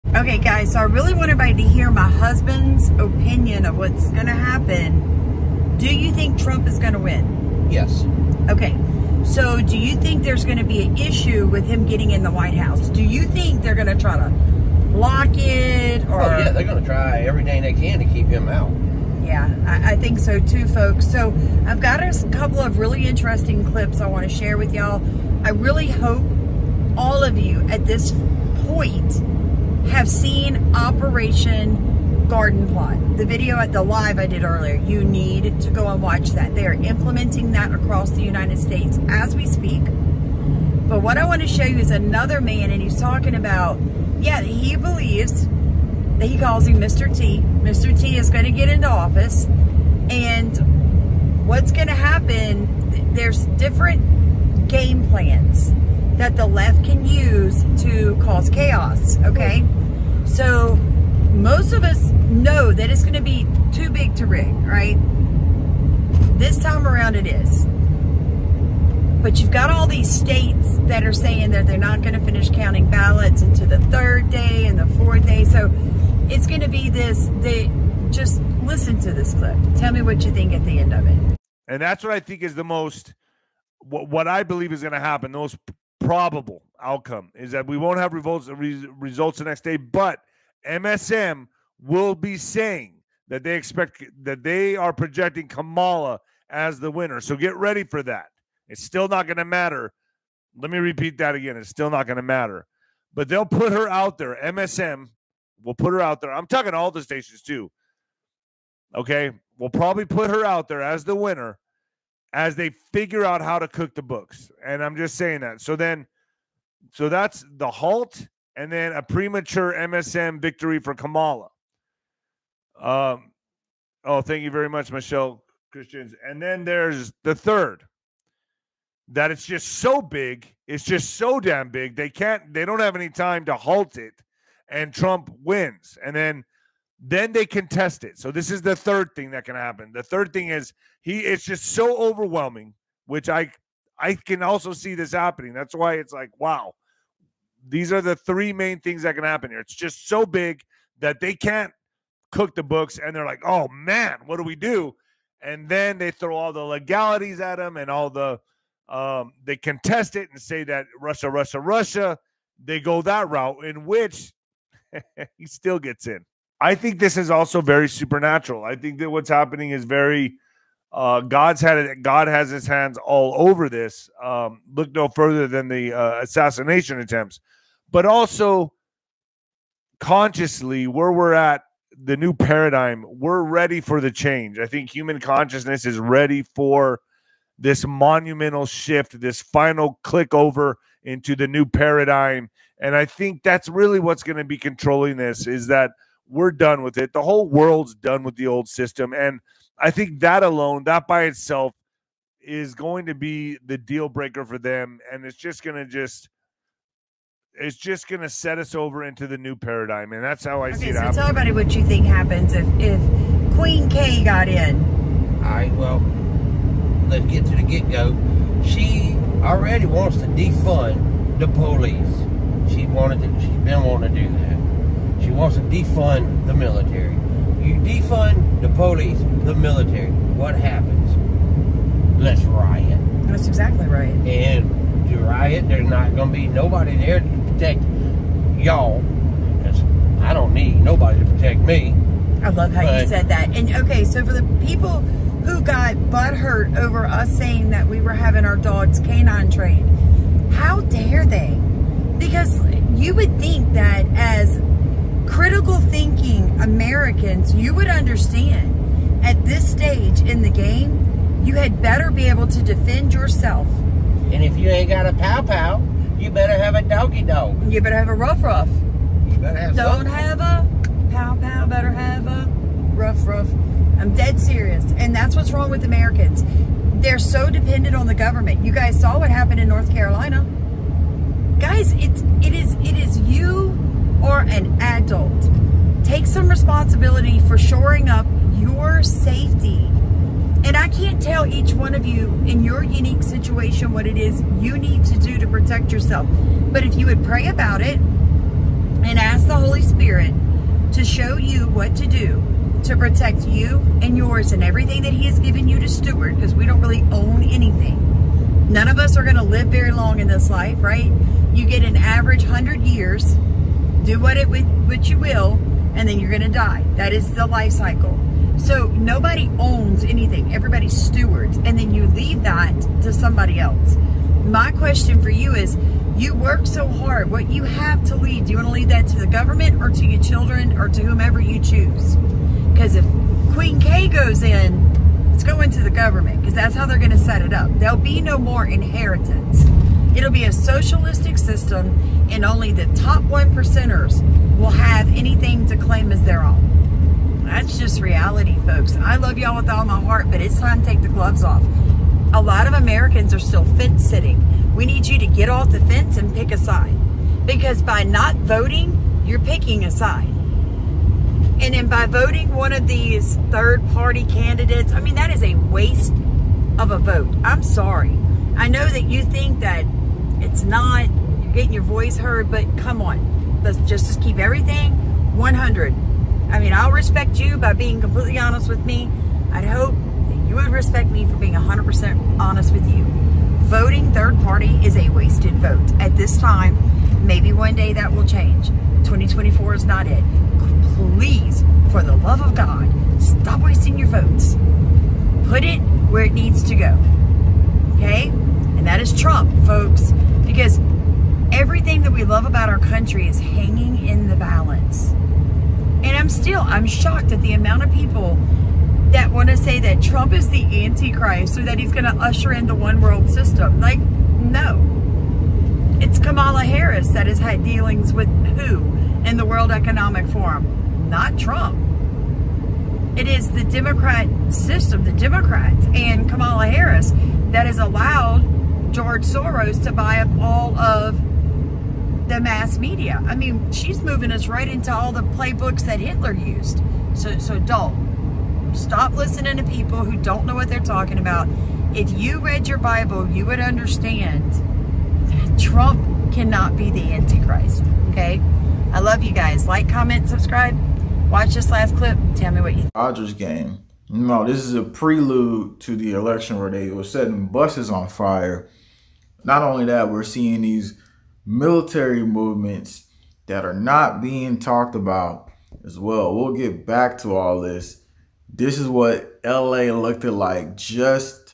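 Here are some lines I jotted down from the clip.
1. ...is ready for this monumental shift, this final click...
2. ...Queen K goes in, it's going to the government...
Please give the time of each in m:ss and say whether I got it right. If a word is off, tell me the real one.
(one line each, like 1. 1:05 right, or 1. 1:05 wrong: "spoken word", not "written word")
1. 3:05 right
2. 5:33 right.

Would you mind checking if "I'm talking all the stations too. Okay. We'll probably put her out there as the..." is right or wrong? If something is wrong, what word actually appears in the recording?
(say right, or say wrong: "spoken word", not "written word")
right.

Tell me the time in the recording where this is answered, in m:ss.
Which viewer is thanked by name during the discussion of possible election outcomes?
2:04.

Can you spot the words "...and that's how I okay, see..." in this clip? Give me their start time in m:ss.
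3:30.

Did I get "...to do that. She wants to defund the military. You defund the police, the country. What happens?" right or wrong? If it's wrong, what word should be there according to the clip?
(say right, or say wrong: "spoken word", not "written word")
wrong: "military", not "country".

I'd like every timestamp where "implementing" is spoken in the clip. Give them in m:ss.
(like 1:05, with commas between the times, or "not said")
0:36.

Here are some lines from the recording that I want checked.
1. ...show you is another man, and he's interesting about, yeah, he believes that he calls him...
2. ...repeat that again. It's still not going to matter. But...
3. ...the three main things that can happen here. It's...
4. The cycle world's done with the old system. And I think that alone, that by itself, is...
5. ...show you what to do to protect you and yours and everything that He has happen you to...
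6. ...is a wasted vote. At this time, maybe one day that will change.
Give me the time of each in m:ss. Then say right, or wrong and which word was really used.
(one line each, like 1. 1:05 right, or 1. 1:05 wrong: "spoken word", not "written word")
1. 0:41 wrong: "talking", not "interesting"
2. 1:40 right
3. 2:28 right
4. 3:17 wrong: "whole", not "cycle"
5. 5:01 wrong: "given", not "happen"
6. 6:24 right.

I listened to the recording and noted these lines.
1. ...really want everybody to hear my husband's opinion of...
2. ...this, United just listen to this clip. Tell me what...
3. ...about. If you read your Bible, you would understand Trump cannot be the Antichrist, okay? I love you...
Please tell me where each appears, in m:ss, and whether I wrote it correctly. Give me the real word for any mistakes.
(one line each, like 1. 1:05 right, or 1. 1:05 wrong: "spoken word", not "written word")
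1. 0:00 right
2. 1:16 wrong: "They", not "United"
3. 7:21 right.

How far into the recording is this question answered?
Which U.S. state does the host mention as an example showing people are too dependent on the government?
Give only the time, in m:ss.
4:39.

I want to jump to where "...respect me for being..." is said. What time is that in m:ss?
6:20.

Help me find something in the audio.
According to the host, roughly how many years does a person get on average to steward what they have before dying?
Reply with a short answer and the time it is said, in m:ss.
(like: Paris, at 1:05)
100 years, at 5:12.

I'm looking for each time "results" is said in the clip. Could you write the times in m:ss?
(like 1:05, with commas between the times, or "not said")
1:28.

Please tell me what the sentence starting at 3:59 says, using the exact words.
Because I don't need nobody to protect me.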